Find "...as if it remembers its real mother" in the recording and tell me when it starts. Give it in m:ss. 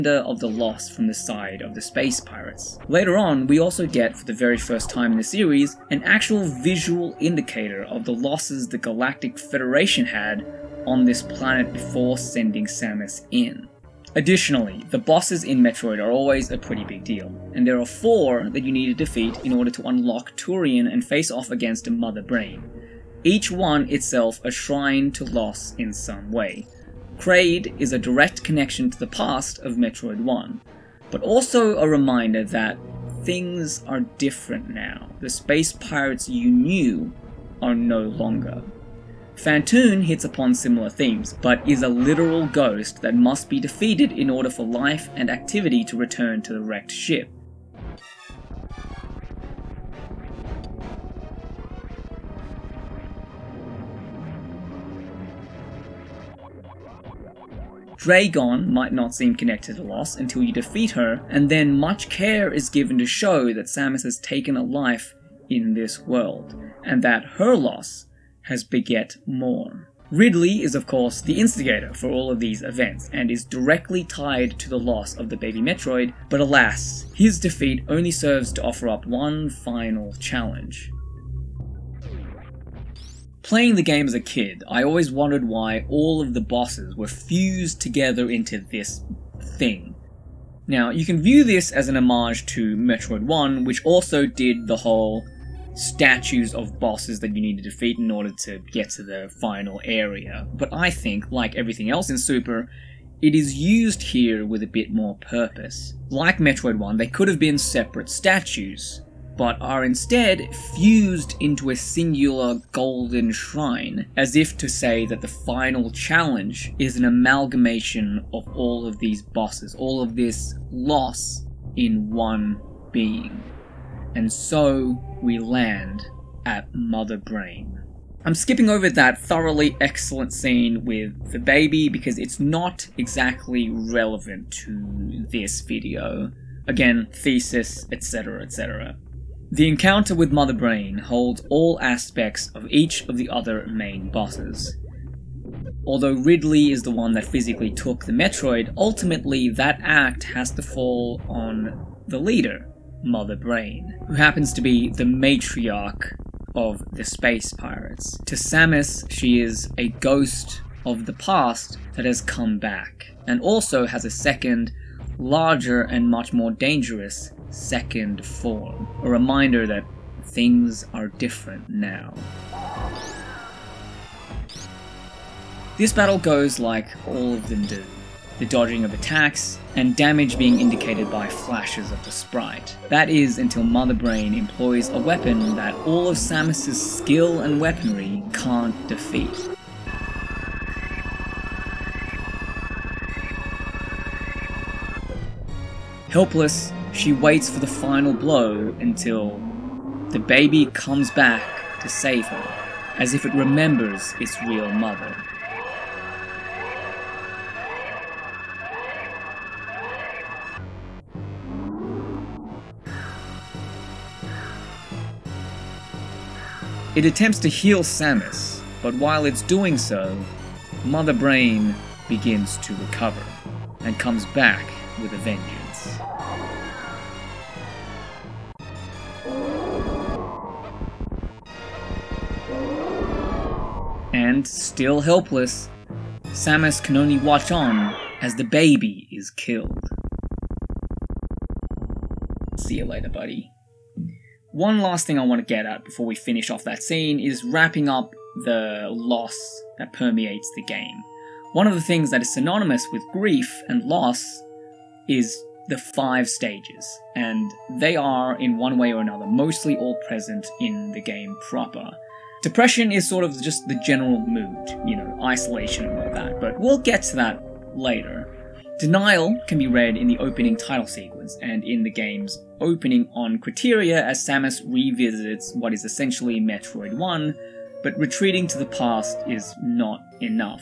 3:22.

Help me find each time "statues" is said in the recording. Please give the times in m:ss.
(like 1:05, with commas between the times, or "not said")
1:35, 1:48.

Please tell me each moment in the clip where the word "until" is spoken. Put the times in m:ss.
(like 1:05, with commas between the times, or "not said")
1:00, 3:03, 3:18.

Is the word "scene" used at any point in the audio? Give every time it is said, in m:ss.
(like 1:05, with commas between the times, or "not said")
2:10, 4:06.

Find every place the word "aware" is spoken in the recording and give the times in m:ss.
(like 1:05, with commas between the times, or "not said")
not said.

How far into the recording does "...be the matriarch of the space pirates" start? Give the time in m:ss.
2:34.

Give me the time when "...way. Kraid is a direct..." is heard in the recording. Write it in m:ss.
0:26.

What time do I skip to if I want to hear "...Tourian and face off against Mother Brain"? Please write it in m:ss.
0:20.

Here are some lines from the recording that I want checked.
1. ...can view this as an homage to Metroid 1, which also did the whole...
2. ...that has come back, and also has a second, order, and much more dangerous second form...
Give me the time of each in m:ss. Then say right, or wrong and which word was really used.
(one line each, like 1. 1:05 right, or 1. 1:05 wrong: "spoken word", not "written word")
1. 1:31 right
2. 2:41 wrong: "larger", not "order".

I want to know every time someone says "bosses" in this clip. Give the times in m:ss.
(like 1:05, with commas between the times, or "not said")
0:14, 1:26, 1:36, 1:59, 2:24.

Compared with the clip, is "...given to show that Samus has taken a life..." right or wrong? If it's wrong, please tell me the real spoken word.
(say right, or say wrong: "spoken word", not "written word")
right.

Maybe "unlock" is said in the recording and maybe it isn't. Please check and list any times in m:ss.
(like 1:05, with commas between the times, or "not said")
0:19.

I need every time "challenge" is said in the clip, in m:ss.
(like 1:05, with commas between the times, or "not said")
1:20, 1:55.